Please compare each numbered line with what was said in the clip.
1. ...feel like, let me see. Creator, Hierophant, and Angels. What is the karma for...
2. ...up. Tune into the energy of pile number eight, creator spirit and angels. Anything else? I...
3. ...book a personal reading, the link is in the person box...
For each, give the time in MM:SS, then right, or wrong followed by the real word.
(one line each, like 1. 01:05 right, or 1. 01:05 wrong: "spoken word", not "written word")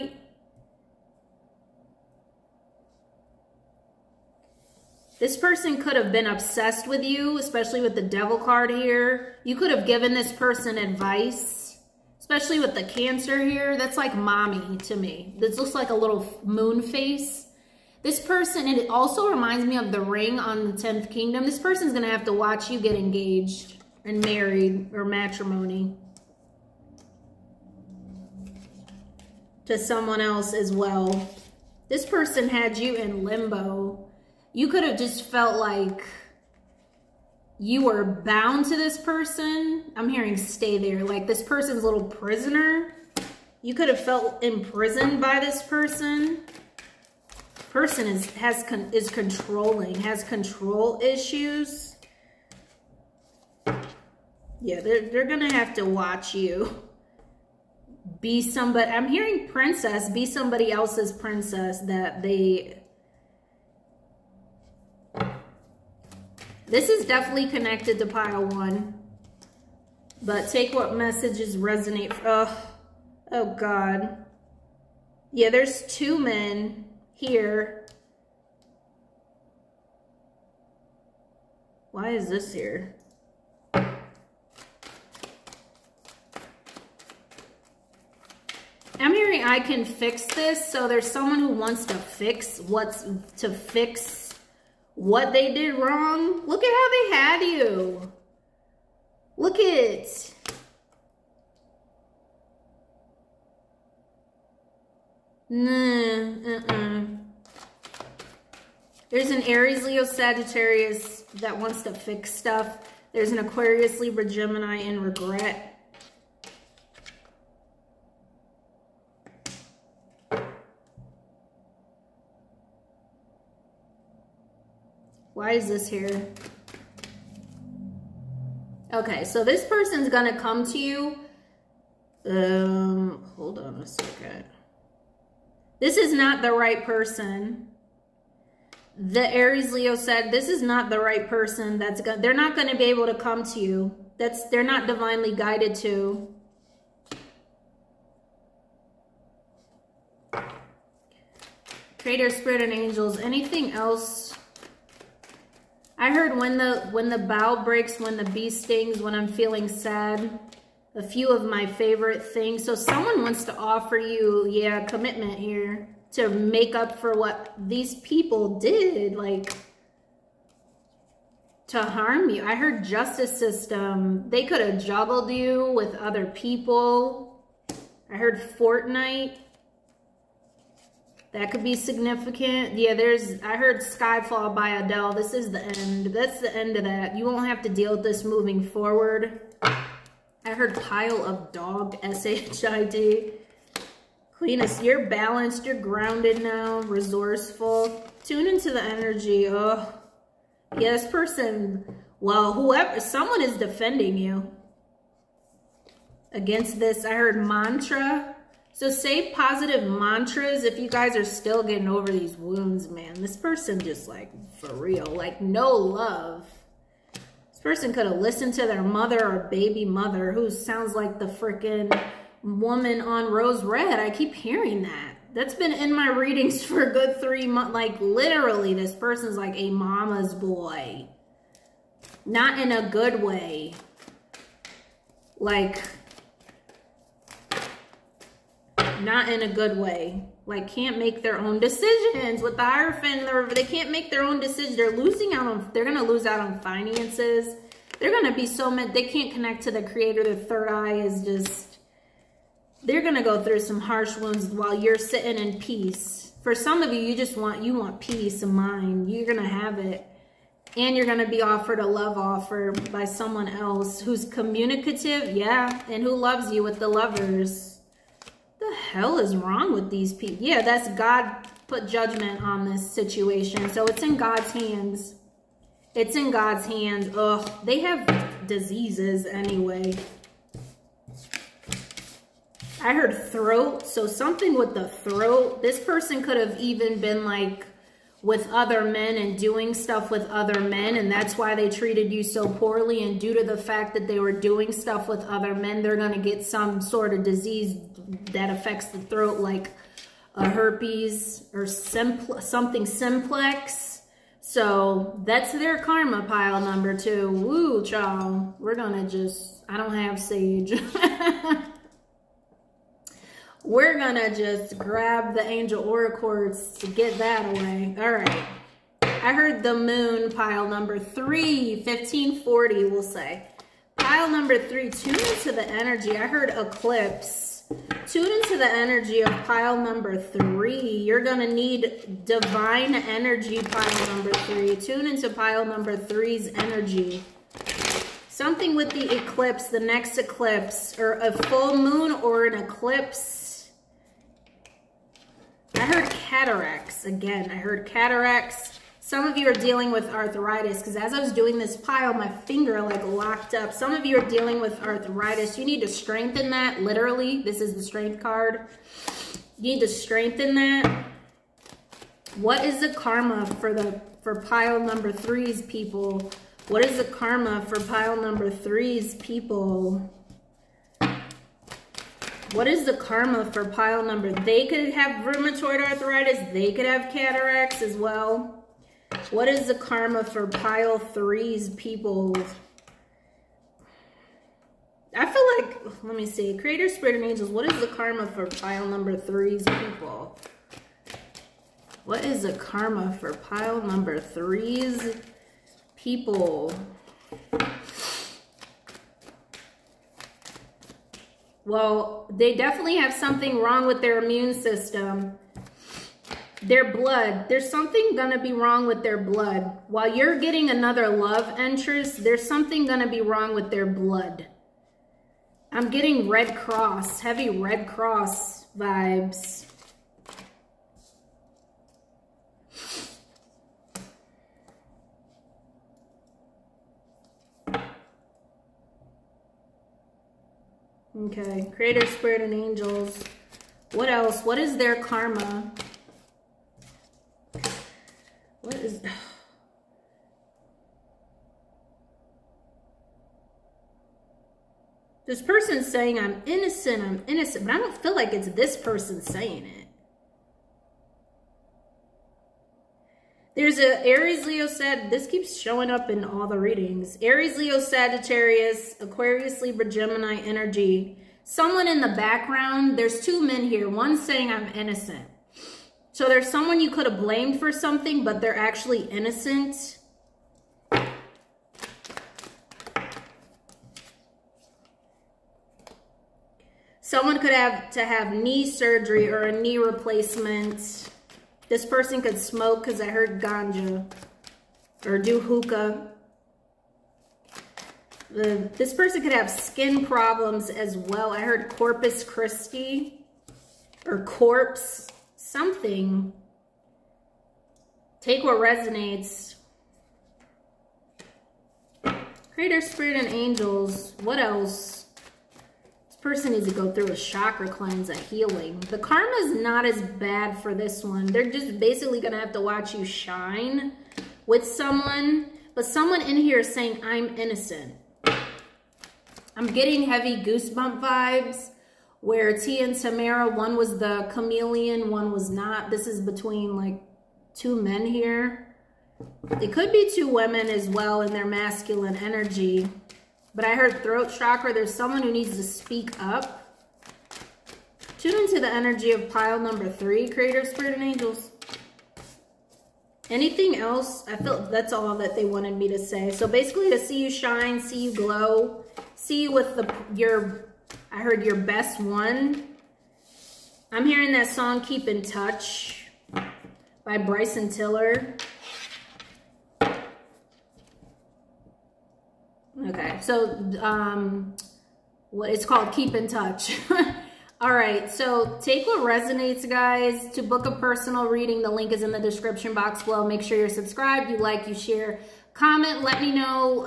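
1. 06:25 wrong: "Spirit", not "Hierophant"
2. 08:56 wrong: "three", not "eight"
3. 09:30 wrong: "description", not "person".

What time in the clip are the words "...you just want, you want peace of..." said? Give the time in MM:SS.
04:16.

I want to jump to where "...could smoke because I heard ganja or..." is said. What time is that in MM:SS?
08:02.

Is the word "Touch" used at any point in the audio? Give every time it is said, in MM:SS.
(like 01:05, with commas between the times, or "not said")
09:15, 09:26.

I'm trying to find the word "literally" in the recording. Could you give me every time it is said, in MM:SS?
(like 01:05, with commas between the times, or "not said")
03:47, 05:56.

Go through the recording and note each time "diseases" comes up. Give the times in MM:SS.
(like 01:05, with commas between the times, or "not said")
04:38, 04:57.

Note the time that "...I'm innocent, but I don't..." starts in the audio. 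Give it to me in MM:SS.
07:27.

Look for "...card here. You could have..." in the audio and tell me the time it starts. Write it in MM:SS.
00:08.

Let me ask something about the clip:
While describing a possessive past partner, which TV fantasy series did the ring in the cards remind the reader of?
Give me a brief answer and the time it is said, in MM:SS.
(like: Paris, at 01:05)
The 10th Kingdom, at 00:20.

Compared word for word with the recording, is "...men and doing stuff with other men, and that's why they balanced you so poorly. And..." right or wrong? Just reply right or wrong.
wrong.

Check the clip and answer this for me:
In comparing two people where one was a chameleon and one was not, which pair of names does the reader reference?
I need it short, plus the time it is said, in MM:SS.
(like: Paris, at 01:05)
T and Tamara, at 08:42.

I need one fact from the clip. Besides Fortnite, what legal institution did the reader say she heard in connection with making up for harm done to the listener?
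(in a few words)
Justice system.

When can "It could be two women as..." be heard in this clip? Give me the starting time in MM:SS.
08:49.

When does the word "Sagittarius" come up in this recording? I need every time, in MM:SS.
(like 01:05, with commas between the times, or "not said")
01:50, 07:37.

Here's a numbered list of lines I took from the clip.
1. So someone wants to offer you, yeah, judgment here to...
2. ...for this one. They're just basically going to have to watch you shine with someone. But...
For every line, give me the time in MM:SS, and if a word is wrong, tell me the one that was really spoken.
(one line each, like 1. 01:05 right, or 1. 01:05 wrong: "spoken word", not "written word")
1. 02:42 wrong: "commitment", not "judgment"
2. 08:30 right.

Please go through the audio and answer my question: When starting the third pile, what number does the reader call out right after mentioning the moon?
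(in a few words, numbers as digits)
1540.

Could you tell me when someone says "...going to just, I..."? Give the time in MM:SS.
05:08.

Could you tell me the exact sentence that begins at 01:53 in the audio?
There's an Aquarius, Libra, Gemini, and regret.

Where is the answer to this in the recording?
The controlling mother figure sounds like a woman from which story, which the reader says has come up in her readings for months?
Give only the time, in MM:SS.
03:43.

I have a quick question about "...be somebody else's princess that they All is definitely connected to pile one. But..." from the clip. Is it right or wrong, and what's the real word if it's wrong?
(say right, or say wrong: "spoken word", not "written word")
wrong: "This", not "All".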